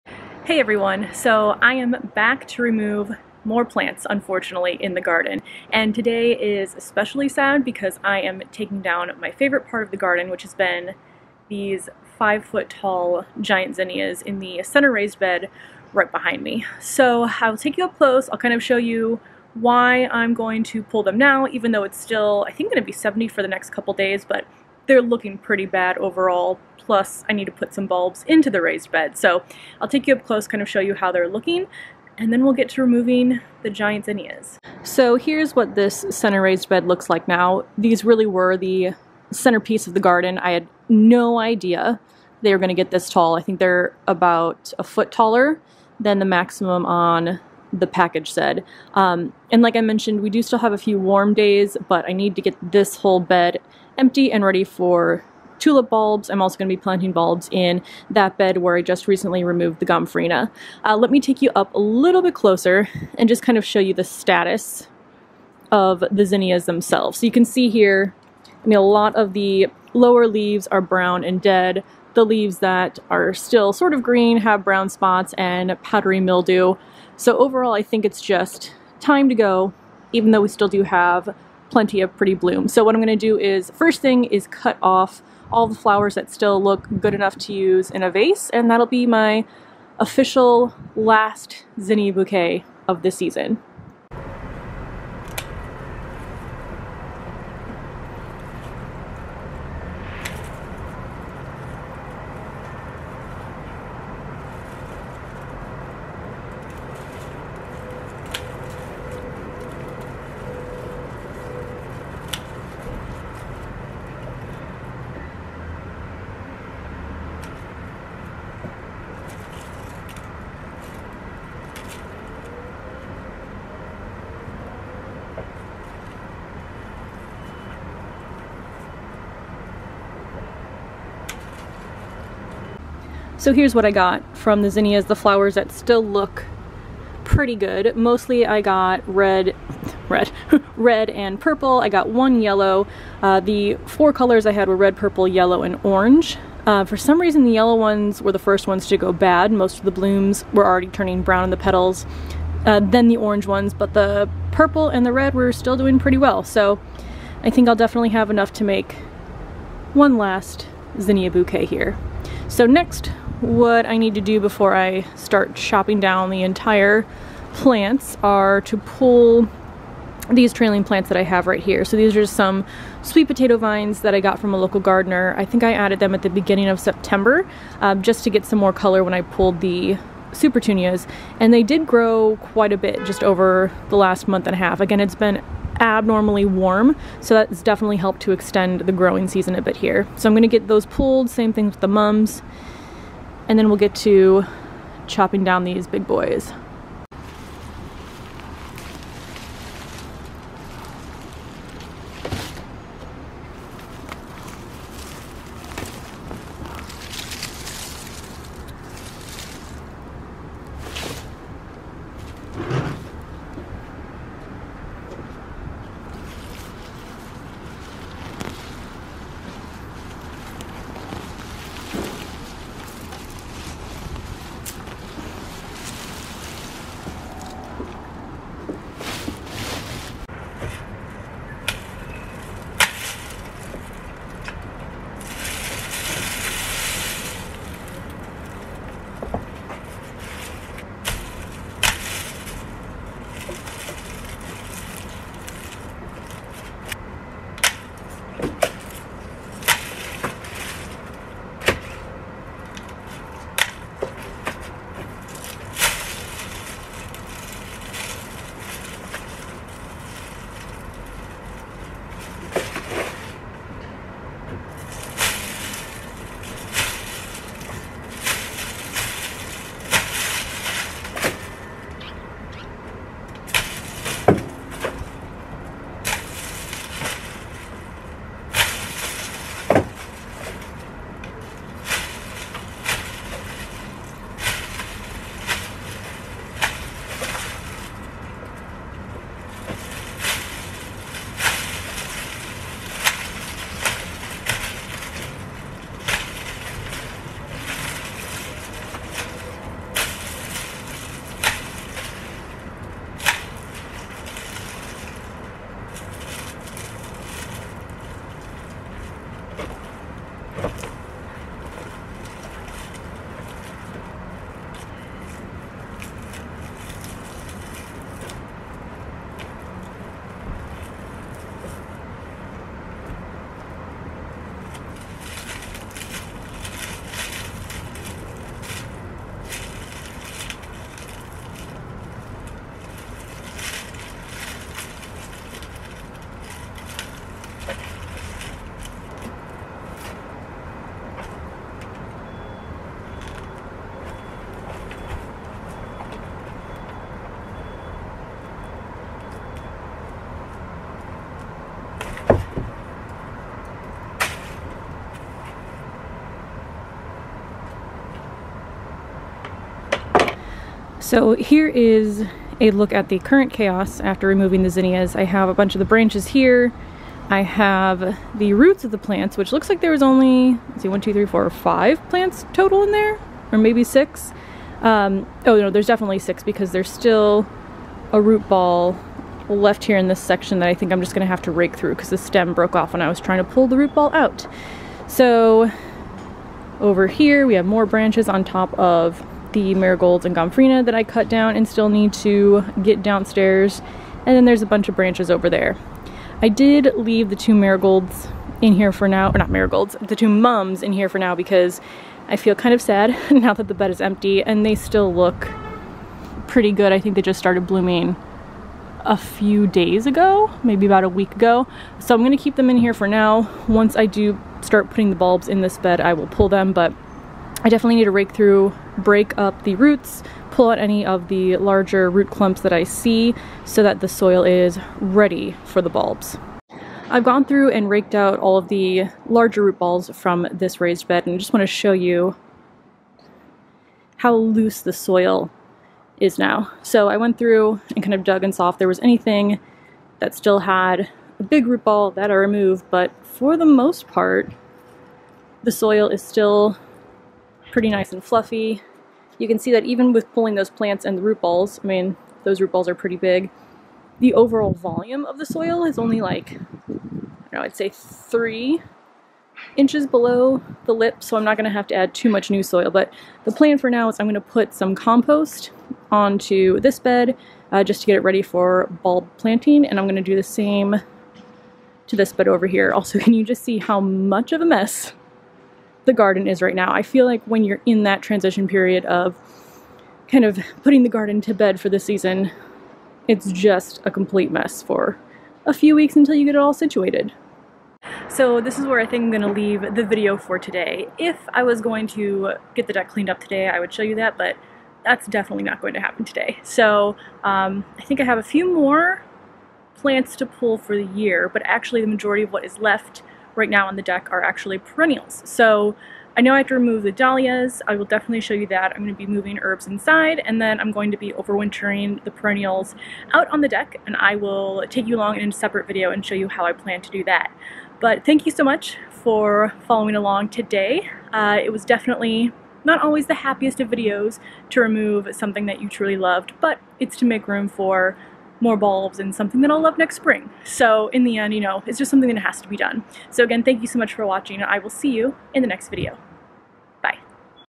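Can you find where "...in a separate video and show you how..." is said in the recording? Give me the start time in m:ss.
8:35.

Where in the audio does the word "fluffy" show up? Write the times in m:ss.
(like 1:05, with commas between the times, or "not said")
7:28.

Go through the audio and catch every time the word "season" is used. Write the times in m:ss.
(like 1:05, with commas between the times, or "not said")
1:33, 3:09, 8:01.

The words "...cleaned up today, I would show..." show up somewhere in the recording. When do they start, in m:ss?
8:13.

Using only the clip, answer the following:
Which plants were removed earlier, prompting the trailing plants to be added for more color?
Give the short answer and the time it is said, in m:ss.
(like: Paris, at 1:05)
Supertunias, at 3:00.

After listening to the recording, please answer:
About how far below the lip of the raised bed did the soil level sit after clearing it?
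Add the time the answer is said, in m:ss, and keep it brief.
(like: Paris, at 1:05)
3 inches, at 7:37.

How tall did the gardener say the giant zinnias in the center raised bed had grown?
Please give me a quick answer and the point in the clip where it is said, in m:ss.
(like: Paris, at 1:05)
5 feet, at 0:12.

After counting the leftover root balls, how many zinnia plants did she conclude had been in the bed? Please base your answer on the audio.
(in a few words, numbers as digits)
6.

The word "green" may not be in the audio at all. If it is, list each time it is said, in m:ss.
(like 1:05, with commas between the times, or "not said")
1:14.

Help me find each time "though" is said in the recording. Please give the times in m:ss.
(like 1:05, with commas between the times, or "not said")
0:21, 1:20.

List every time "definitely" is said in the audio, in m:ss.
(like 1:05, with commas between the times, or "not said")
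2:37, 3:07, 6:15, 6:57, 8:15, 8:28, 8:41.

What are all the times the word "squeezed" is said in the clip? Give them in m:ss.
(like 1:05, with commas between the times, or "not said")
not said.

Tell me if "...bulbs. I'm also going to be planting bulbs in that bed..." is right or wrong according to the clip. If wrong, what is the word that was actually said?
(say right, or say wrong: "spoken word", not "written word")
right.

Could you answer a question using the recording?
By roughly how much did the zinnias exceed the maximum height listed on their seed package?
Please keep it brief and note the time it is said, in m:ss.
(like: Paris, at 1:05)
a foot, at 0:44.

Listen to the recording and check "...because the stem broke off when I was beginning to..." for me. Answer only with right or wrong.
wrong.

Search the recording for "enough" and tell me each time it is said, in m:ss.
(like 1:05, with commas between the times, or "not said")
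1:27, 2:38.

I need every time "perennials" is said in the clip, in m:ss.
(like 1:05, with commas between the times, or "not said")
8:24, 8:32.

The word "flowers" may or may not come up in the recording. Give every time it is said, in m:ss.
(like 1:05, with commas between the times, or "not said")
1:25, 2:15.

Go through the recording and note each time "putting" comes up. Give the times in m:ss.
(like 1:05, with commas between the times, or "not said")
6:54, 8:00.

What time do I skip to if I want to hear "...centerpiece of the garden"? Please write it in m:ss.
0:39.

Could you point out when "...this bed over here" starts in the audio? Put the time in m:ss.
7:52.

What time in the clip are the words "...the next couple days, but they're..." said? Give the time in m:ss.
0:23.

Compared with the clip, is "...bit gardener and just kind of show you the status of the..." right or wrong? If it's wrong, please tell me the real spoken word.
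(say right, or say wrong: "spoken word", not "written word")
wrong: "closer", not "gardener".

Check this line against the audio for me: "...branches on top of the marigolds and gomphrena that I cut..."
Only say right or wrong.
right.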